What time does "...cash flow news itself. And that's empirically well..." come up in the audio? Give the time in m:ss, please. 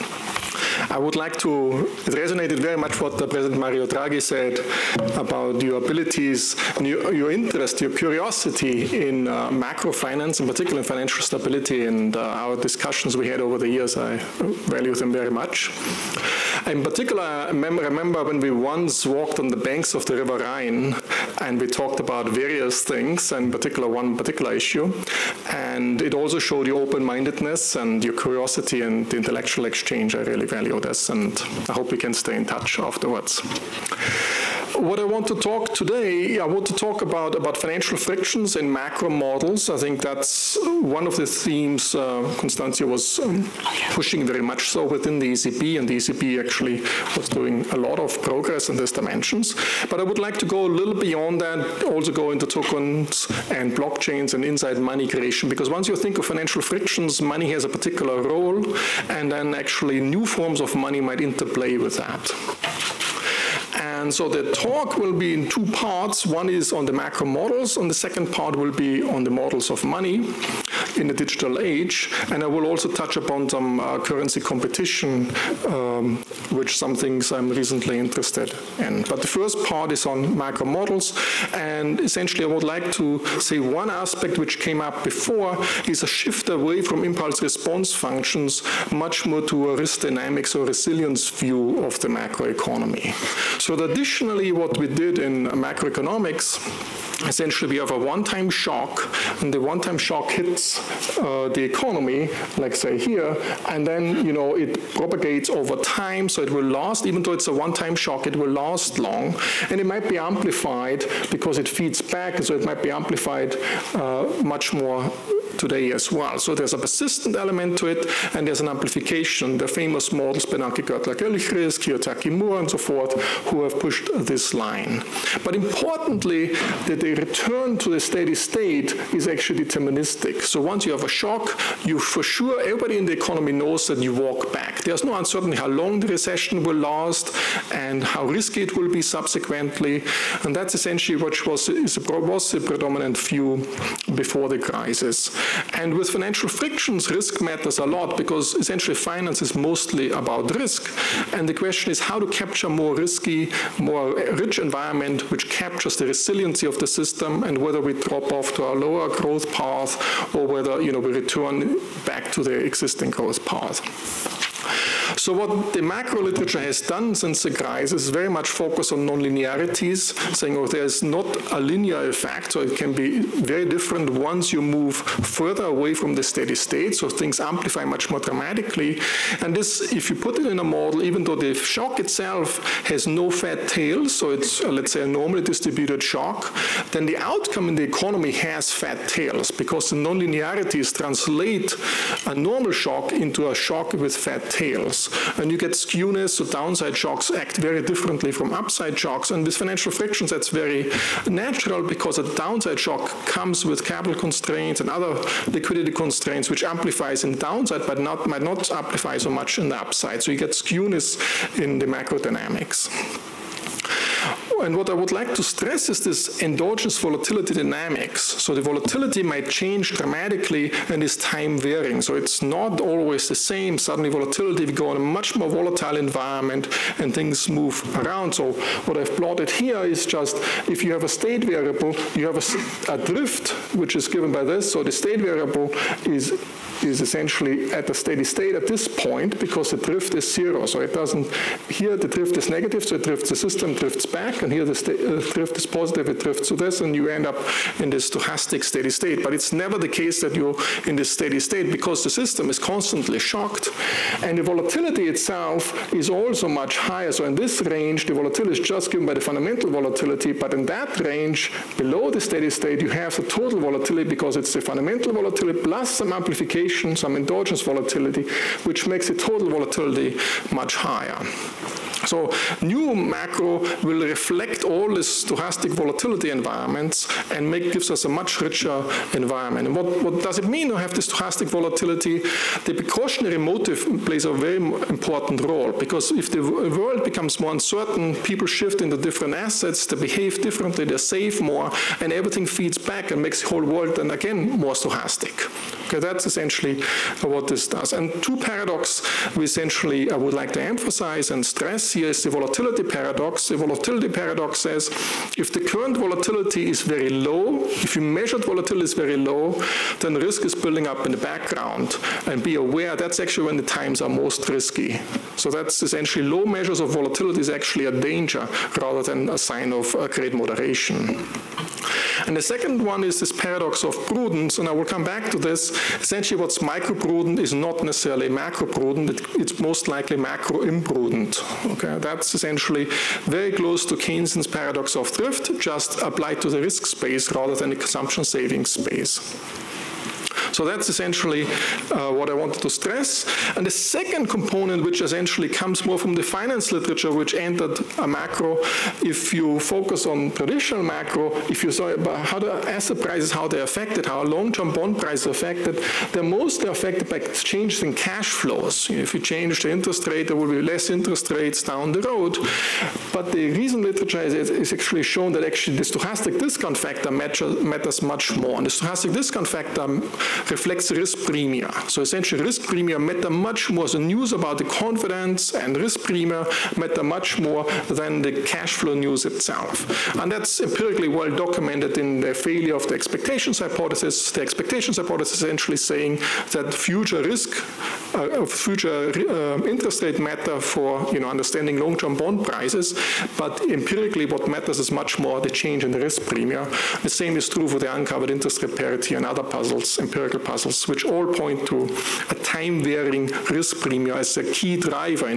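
6:18.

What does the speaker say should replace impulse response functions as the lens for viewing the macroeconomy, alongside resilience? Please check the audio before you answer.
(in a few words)
Risk dynamics.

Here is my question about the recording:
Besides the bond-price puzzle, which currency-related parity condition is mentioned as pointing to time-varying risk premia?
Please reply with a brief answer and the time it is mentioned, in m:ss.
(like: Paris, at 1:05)
Uncovered interest rate parity, at 6:37.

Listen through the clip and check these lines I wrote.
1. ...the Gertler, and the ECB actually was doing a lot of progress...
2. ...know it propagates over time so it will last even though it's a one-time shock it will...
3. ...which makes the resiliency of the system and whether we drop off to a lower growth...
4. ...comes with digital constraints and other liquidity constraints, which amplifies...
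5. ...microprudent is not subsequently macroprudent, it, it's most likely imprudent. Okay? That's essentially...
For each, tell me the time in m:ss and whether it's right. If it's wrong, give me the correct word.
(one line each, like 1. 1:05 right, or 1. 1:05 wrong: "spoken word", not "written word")
1. 0:45 wrong: "ECB", not "Gertler"
2. 1:44 right
3. 2:35 wrong: "captures", not "makes"
4. 3:23 wrong: "capital", not "digital"
5. 5:26 wrong: "necessarily", not "subsequently".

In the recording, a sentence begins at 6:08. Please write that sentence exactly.
And the stochastic discount factor reflects risk premium.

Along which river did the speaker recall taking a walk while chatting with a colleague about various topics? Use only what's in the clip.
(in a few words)
Rhine.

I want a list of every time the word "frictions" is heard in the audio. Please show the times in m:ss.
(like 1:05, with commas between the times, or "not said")
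0:37, 0:56, 2:26, 3:19.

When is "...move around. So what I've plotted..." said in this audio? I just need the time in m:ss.
3:47.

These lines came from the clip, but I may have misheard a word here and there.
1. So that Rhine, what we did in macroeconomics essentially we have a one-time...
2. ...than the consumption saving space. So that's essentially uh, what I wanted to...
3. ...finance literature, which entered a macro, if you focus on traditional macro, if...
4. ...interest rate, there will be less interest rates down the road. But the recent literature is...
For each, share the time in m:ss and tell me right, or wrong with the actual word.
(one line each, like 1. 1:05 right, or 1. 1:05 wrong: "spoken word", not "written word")
1. 1:33 wrong: "Additionally", not "Rhine"
2. 5:37 right
3. 5:46 right
4. 5:59 right.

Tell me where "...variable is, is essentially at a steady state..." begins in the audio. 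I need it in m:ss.
3:55.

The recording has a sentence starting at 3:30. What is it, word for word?
So you get skewness in the macro dynamics and what I would like to stress is this endogenous volatility dynamics.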